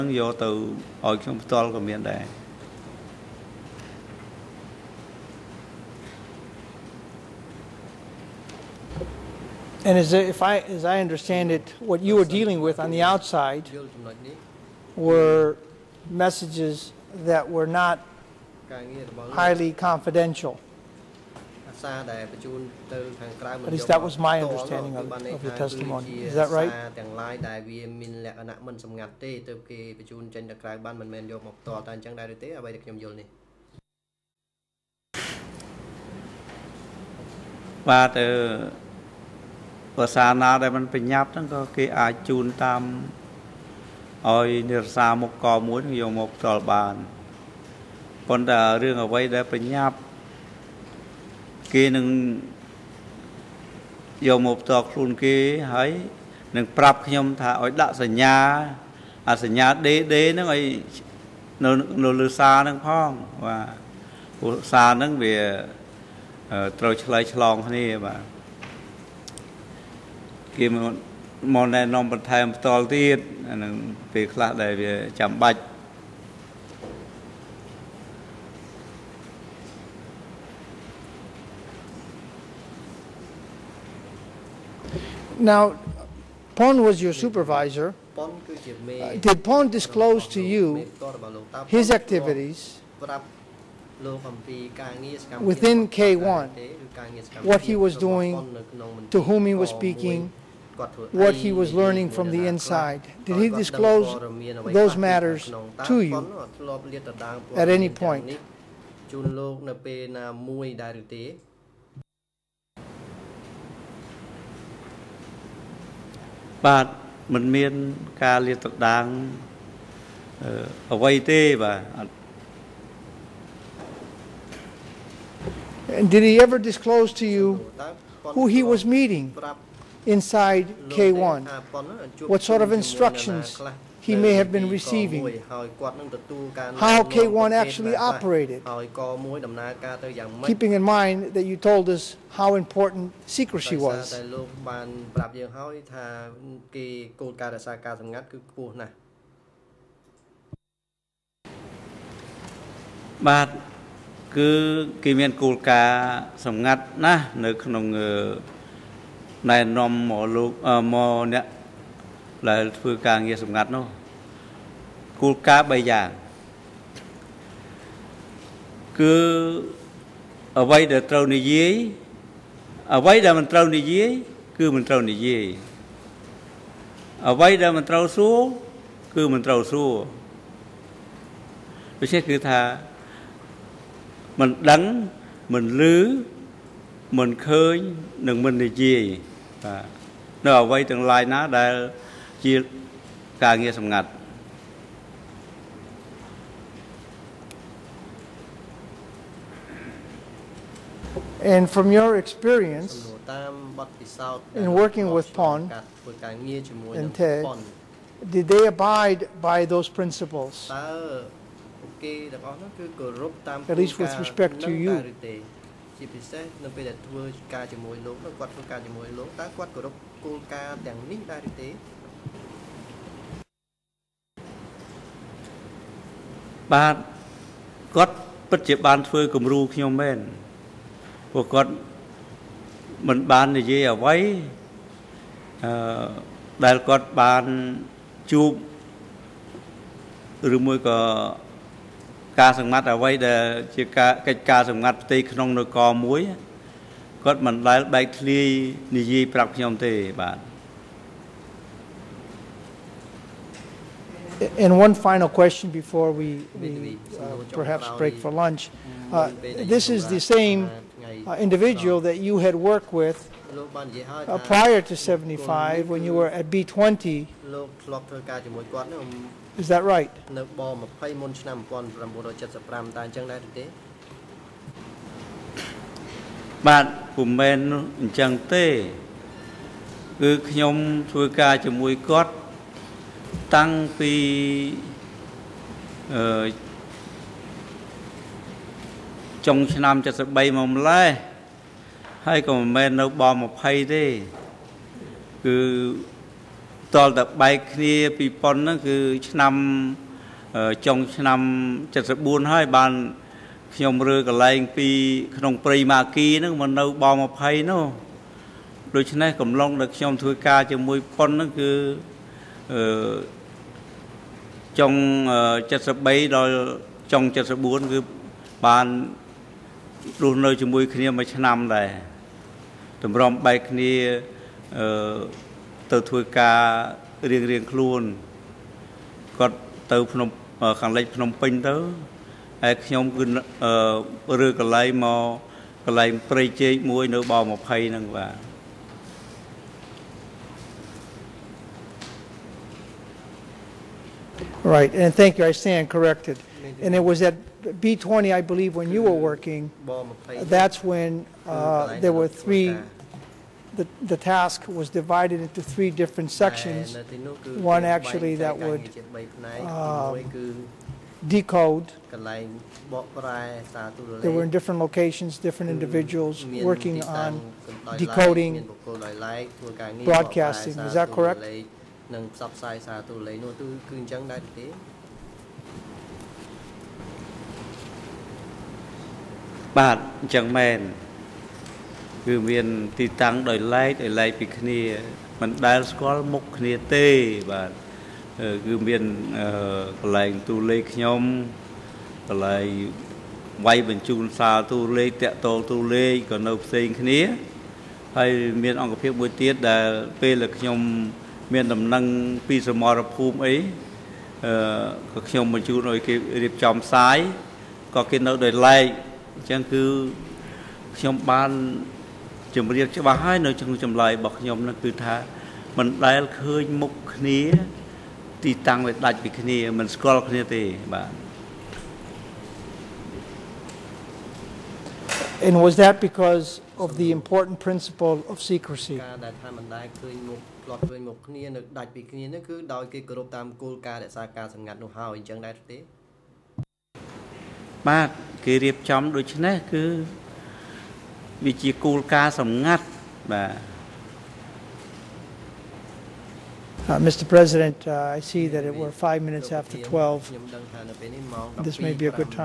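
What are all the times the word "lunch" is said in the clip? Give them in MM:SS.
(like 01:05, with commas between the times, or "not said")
04:18.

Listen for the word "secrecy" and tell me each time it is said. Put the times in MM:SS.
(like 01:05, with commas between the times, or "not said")
02:23, 07:08.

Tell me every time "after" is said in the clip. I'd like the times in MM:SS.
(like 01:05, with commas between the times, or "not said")
07:29.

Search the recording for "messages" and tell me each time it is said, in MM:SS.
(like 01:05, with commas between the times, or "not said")
00:16.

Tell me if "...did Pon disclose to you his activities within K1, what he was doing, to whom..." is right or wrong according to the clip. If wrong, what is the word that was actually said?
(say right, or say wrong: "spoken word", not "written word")
right.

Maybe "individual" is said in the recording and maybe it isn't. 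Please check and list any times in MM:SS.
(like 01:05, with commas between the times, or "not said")
04:21, 06:05.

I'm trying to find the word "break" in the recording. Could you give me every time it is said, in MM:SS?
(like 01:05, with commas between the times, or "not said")
04:17.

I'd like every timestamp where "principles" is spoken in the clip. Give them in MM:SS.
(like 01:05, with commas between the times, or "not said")
03:29, 07:07.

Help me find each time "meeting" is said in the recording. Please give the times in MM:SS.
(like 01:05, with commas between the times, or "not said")
02:08.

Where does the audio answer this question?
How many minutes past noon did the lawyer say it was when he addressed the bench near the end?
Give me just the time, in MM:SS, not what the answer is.
07:29.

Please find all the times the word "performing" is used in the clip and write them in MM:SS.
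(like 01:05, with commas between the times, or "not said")
not said.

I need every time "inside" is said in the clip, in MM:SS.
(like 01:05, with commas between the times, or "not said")
01:42, 02:10.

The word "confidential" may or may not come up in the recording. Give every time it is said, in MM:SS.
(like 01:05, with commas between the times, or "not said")
00:19.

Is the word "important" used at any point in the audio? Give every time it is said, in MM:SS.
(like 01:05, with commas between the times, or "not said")
02:22, 07:07.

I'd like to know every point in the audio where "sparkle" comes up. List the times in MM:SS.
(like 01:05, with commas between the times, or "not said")
not said.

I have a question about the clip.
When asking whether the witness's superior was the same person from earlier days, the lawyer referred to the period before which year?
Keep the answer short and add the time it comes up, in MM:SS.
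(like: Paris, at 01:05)
75, at 04:24.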